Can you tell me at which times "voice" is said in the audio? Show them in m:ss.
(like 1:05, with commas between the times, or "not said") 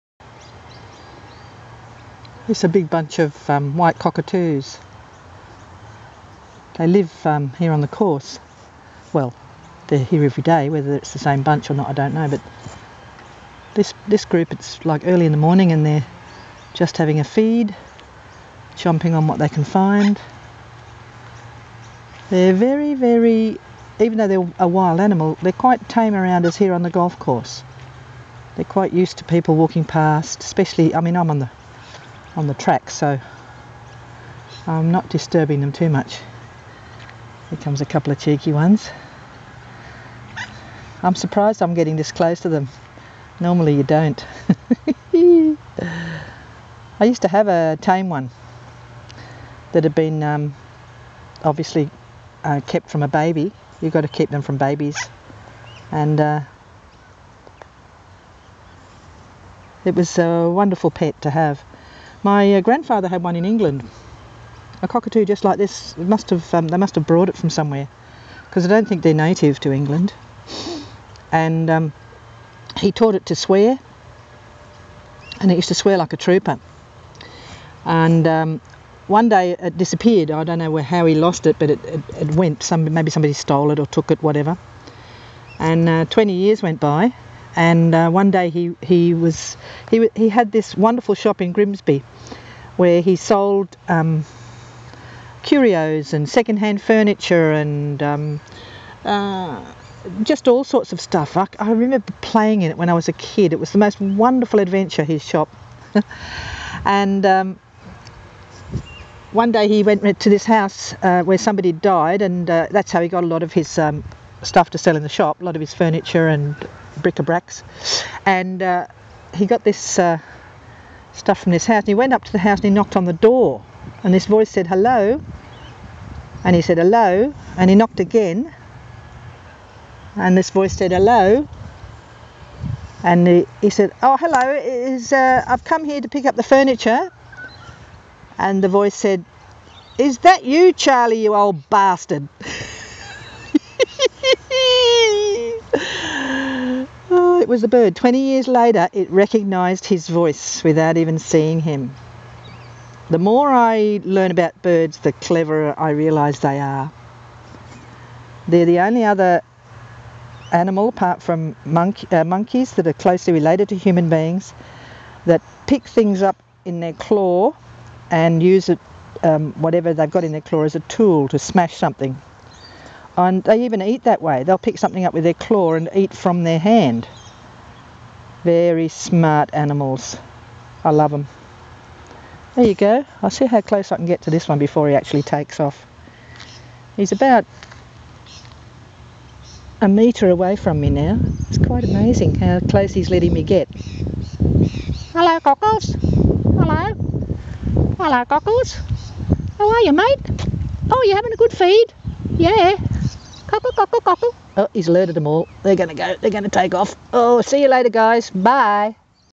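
2:04, 2:10, 2:18, 2:30.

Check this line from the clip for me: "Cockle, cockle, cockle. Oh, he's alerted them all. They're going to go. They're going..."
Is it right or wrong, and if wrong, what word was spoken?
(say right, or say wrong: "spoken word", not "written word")
right.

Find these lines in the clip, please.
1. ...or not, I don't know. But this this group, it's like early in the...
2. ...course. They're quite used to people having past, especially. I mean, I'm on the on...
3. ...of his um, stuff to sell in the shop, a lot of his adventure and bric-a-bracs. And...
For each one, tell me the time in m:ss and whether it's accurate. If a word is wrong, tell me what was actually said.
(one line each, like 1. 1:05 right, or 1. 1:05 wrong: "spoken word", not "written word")
1. 0:11 right
2. 0:27 wrong: "walking", not "having"
3. 1:53 wrong: "furniture", not "adventure".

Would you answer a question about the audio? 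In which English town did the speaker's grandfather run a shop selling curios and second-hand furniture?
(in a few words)
Grimsby.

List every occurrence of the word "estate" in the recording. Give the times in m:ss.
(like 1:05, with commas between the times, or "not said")
not said.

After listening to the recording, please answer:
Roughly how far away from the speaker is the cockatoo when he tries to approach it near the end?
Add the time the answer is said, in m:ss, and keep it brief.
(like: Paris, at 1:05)
1 metre, at 3:09.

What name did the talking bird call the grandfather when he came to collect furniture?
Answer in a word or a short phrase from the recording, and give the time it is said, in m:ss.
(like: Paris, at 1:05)
Charlie, at 2:20.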